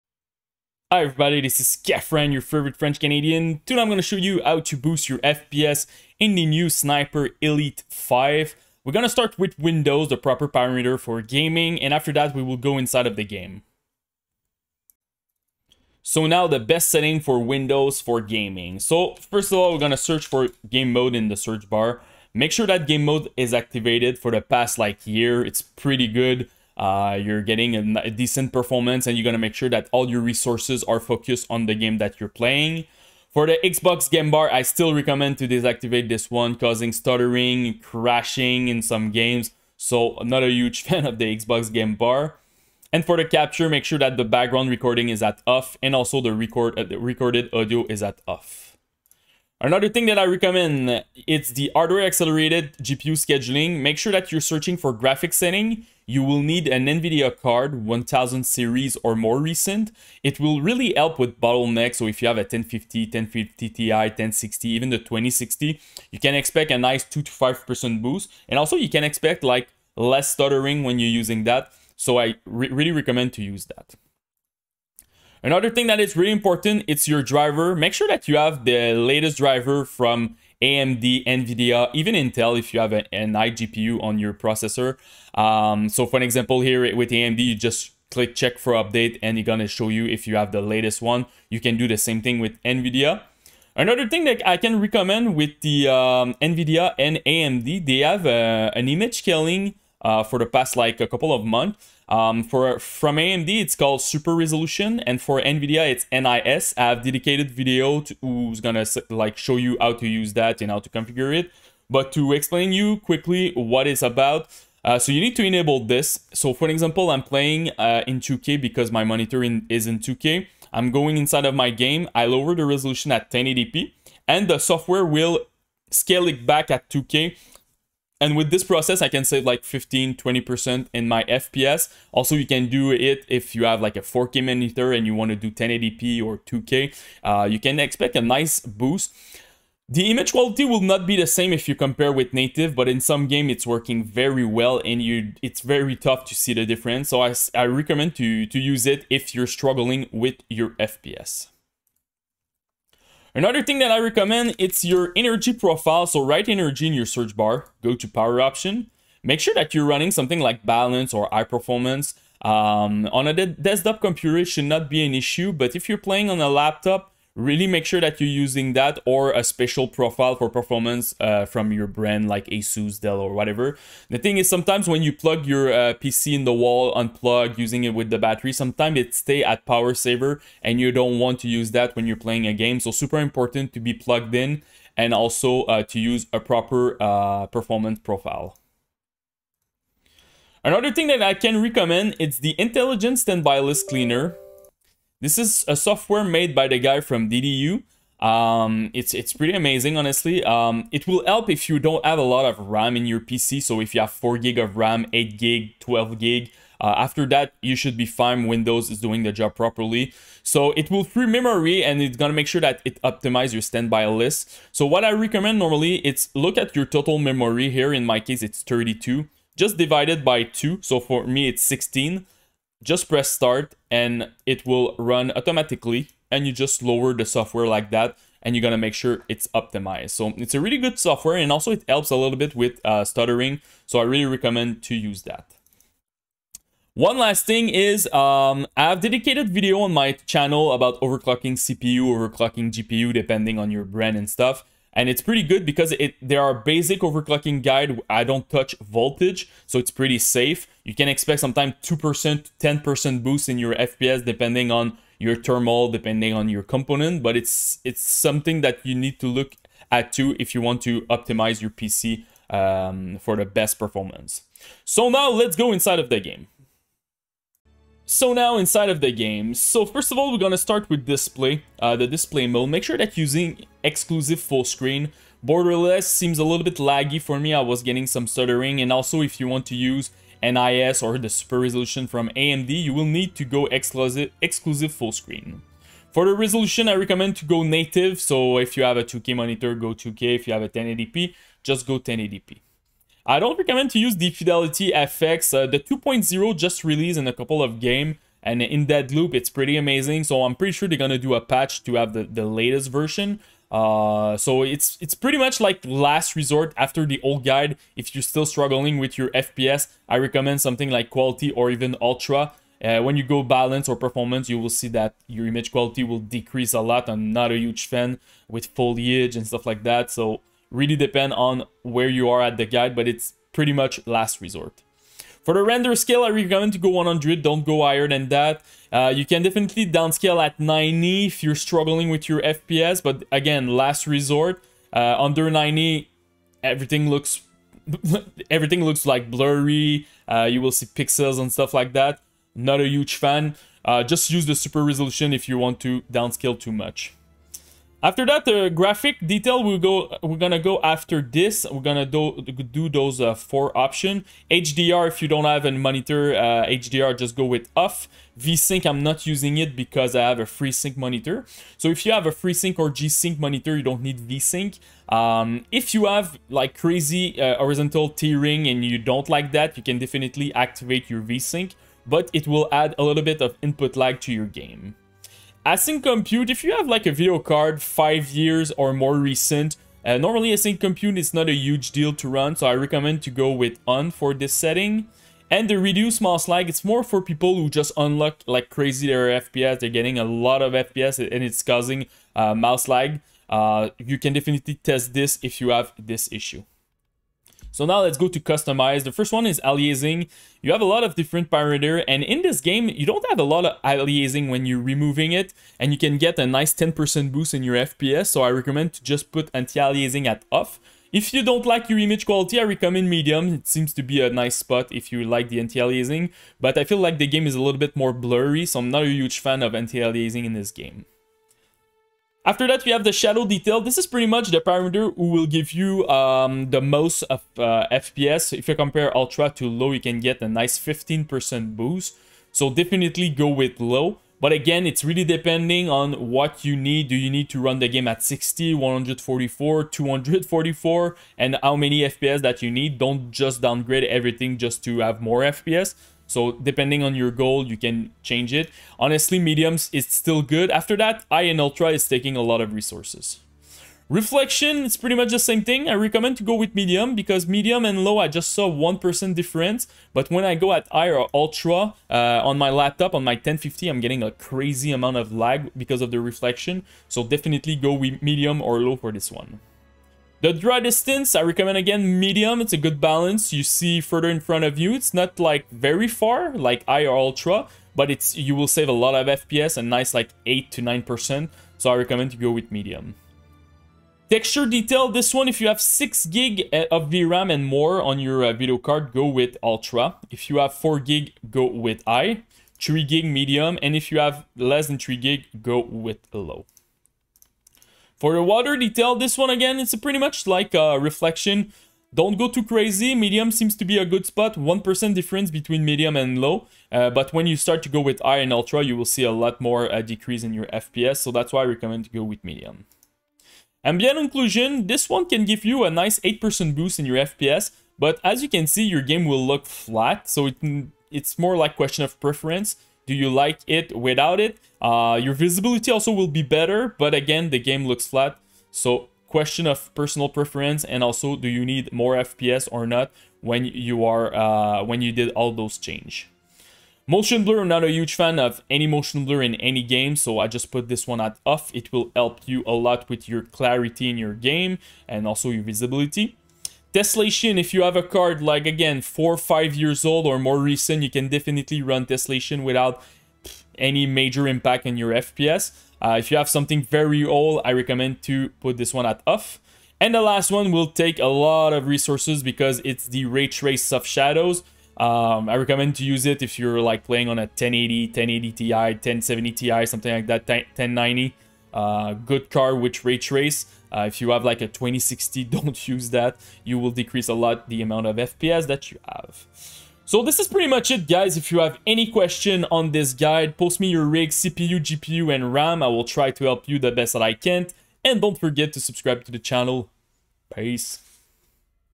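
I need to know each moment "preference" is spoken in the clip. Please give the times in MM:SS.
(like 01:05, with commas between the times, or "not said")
08:42, 08:50.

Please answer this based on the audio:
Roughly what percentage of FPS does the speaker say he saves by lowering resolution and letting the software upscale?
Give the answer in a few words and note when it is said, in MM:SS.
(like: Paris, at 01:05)
15 to 20%, at 02:09.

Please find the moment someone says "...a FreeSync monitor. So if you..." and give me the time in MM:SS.
06:00.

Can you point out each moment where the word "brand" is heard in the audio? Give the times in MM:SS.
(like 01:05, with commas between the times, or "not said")
02:51, 04:03.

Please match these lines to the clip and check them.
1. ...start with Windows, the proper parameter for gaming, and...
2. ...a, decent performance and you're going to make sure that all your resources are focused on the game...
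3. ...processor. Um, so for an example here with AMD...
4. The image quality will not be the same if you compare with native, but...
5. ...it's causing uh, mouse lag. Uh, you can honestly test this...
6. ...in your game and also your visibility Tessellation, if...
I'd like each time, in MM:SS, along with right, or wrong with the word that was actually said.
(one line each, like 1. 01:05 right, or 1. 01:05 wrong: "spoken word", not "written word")
1. 00:09 right
2. 00:27 right
3. 01:24 right
4. 02:19 right
5. 06:31 wrong: "definitely", not "honestly"
6. 09:04 right.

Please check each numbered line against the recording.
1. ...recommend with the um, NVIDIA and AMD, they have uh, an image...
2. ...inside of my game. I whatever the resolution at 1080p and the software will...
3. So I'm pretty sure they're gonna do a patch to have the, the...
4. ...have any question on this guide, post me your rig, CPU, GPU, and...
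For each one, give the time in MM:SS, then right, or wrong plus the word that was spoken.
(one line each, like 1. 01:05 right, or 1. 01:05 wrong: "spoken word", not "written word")
1. 01:34 right
2. 02:01 wrong: "lower", not "whatever"
3. 05:00 right
4. 09:41 right.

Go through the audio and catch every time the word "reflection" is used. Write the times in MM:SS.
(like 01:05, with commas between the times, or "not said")
07:34, 07:46, 08:20.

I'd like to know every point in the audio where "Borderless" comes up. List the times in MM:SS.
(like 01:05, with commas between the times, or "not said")
04:35.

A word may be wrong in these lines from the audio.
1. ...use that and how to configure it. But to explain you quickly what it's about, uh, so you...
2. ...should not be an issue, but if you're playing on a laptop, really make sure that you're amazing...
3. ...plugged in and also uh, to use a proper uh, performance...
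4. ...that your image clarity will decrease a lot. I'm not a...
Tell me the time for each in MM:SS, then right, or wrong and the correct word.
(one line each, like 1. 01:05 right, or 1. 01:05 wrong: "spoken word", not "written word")
1. 01:50 right
2. 02:44 wrong: "using", not "amazing"
3. 03:03 right
4. 05:14 wrong: "quality", not "clarity".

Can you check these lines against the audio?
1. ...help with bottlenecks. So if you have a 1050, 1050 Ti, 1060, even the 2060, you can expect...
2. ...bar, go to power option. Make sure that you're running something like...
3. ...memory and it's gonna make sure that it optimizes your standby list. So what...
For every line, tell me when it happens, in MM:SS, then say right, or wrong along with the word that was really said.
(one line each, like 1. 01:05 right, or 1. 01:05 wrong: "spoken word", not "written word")
1. 01:00 right
2. 02:37 right
3. 03:31 right.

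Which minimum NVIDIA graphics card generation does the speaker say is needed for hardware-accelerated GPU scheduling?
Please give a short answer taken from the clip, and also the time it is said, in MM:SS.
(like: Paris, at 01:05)
1000 series, at 00:57.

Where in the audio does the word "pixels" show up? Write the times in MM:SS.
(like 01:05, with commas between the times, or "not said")
05:40.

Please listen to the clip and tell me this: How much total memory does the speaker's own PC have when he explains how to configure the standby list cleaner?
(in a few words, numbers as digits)
32 GB.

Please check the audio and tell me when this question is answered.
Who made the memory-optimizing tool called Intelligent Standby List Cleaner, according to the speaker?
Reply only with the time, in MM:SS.
03:16.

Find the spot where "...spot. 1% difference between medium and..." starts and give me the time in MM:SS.
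08:24.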